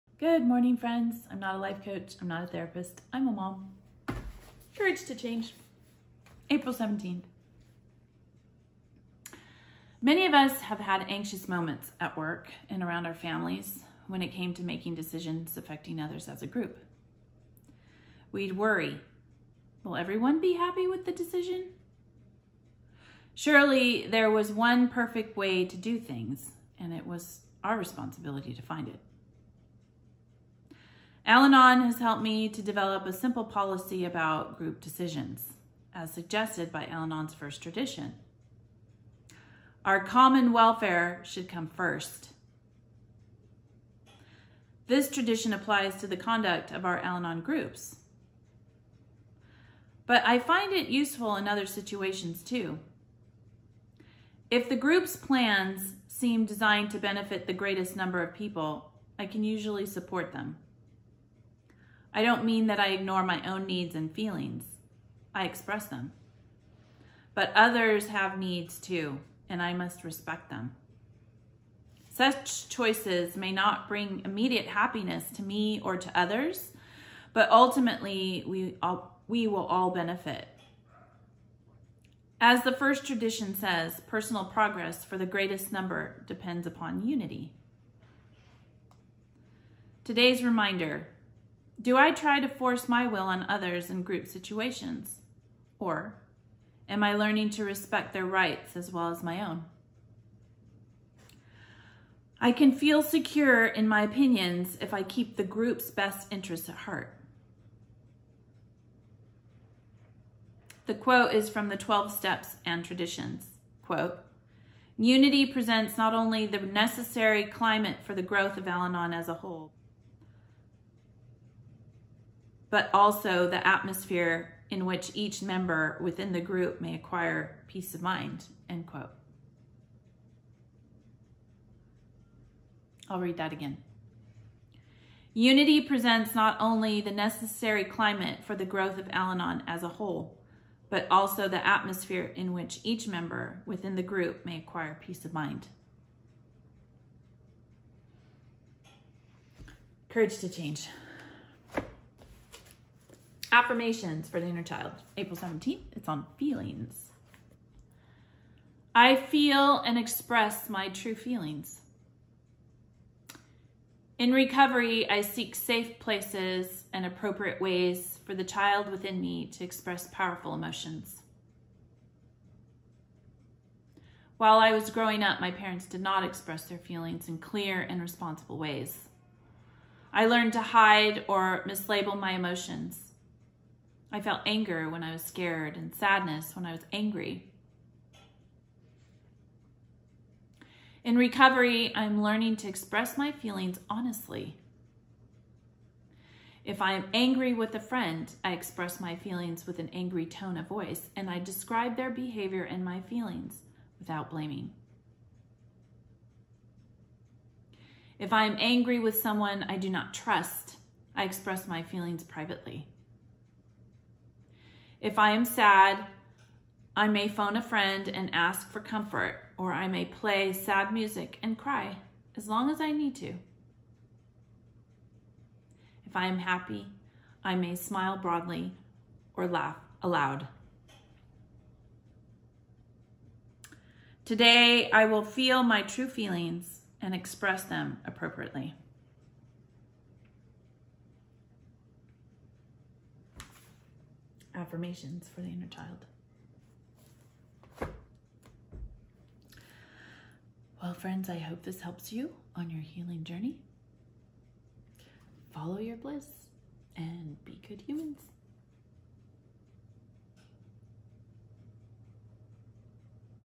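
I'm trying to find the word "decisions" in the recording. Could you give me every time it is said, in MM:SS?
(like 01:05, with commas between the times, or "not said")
00:14, 00:21, 00:34.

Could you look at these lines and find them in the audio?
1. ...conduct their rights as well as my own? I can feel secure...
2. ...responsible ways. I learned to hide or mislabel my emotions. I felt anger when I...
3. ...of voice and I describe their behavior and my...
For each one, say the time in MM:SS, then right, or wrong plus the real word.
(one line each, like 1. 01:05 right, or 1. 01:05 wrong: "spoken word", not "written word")
1. 01:37 wrong: "respect", not "conduct"
2. 02:58 right
3. 03:20 right.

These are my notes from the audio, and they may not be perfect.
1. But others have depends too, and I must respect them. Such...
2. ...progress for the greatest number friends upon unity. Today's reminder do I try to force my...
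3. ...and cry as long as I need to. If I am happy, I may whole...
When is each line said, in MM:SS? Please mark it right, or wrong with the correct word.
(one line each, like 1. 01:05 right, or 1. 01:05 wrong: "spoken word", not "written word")
1. 01:07 wrong: "needs", not "depends"
2. 01:24 wrong: "depends", not "friends"
3. 03:41 wrong: "smile", not "whole".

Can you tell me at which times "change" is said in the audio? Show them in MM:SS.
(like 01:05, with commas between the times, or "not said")
00:05, 02:30.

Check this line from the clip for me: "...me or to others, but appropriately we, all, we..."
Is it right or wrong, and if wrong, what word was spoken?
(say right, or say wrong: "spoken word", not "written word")
wrong: "ultimately", not "appropriately".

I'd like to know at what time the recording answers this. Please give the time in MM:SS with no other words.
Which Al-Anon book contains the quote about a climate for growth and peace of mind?
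01:51.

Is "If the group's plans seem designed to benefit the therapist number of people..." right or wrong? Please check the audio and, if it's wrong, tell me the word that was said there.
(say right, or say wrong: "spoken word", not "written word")
wrong: "greatest", not "therapist".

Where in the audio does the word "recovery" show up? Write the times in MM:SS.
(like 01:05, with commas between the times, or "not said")
02:44, 03:11.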